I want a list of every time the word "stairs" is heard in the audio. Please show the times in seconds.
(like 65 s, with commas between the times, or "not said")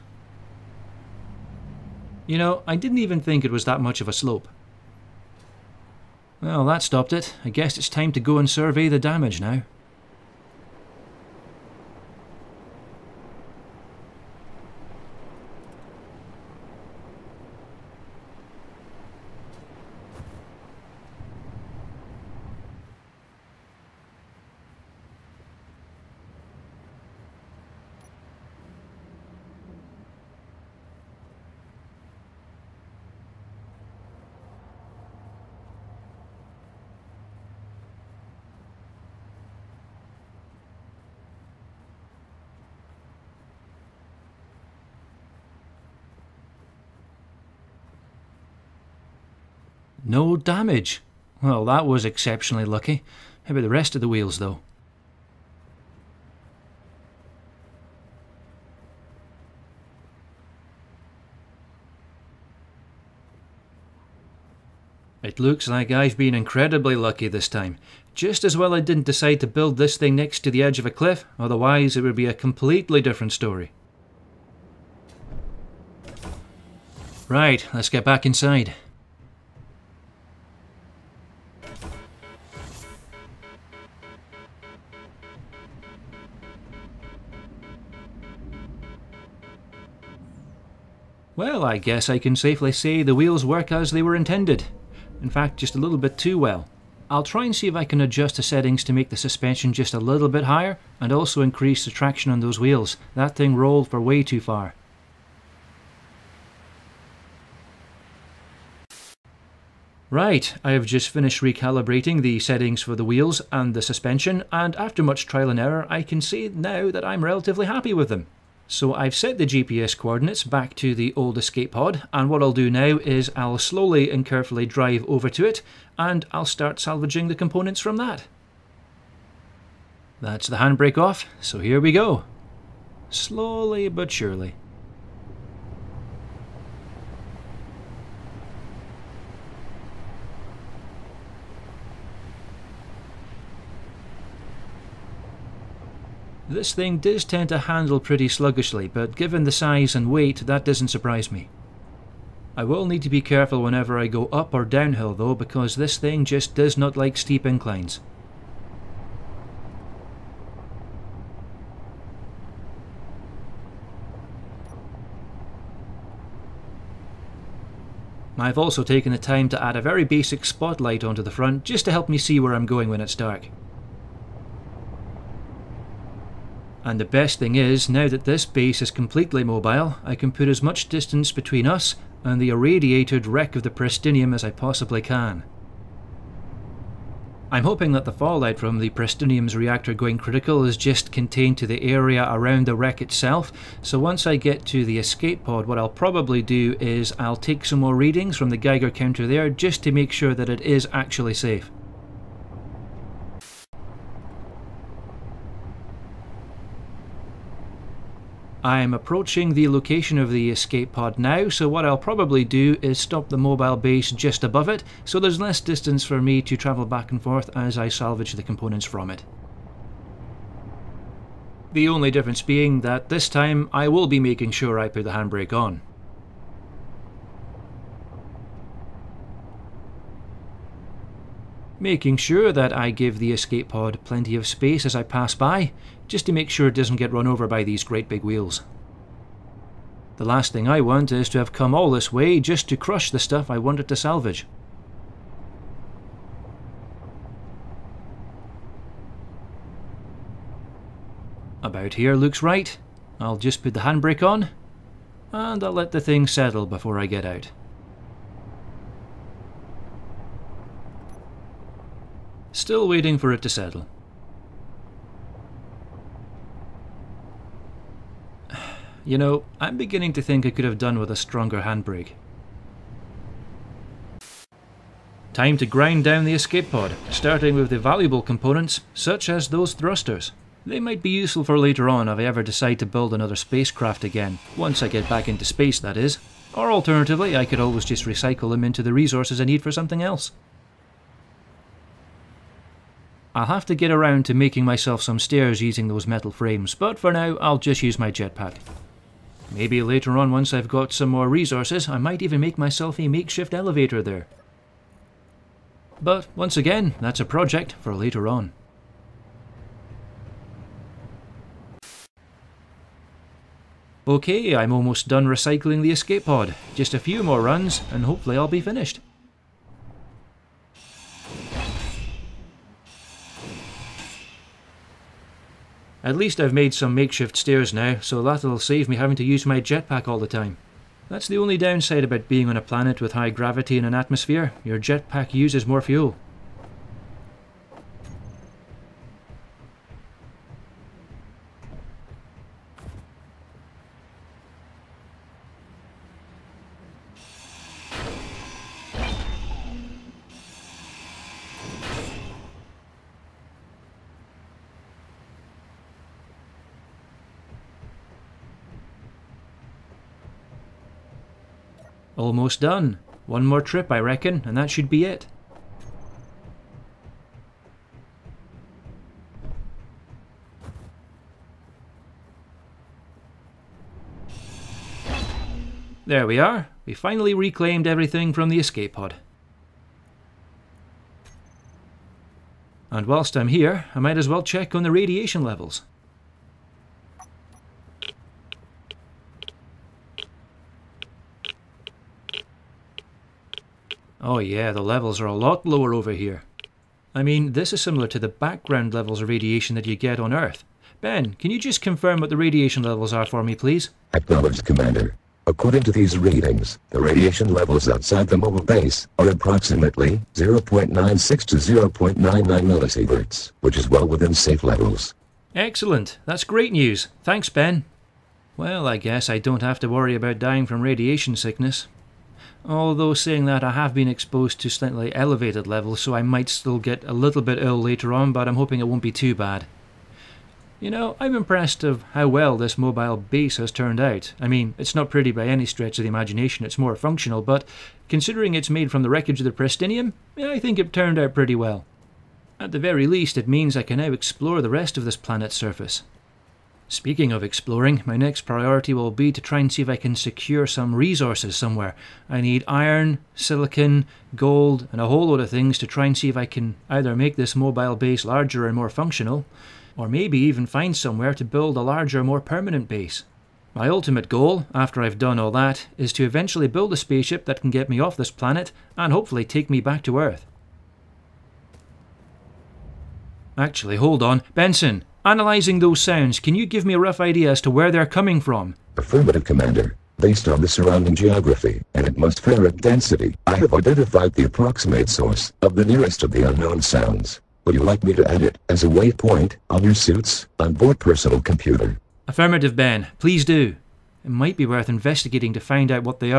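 295 s, 327 s.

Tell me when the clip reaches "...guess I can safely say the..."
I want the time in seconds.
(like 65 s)
91 s.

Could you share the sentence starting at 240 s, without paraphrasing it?
The last thing I want is to have come all this way just to crush the stuff I wanted to salvage.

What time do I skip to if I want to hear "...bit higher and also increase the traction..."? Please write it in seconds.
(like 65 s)
100 s.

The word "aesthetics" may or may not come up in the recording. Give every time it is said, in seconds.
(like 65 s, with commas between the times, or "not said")
not said.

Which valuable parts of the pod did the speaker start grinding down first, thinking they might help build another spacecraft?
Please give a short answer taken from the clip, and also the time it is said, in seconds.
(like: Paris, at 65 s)
Thrusters, at 279 s.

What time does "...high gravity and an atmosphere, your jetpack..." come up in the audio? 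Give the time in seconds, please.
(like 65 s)
333 s.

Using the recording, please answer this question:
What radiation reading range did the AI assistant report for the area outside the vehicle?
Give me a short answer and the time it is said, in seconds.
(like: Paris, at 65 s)
0.96 to 0.99 millisieverts, at 410 s.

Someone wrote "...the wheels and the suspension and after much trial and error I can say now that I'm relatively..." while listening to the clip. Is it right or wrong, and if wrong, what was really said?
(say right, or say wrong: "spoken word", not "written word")
right.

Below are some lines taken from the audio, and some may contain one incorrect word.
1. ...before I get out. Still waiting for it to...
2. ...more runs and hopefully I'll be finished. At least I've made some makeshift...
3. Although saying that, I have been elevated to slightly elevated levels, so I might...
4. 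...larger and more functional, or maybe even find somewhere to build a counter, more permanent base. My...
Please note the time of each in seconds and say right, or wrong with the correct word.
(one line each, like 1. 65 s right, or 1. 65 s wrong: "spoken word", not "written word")
1. 256 s right
2. 317 s right
3. 422 s wrong: "exposed", not "elevated"
4. 458 s wrong: "larger", not "counter".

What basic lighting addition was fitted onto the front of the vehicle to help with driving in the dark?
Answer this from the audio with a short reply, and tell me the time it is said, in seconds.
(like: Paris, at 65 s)
Spotlight, at 170 s.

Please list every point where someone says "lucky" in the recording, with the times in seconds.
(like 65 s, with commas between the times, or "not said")
52 s, 66 s.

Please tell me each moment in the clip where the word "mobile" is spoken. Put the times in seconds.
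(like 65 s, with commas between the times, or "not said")
179 s, 213 s, 408 s, 432 s, 457 s.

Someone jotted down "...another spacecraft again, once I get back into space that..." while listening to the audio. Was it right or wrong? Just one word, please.
right.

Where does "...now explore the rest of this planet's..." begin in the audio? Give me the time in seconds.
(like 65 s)
443 s.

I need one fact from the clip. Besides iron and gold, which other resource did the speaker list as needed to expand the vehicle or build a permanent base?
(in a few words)
Silicon.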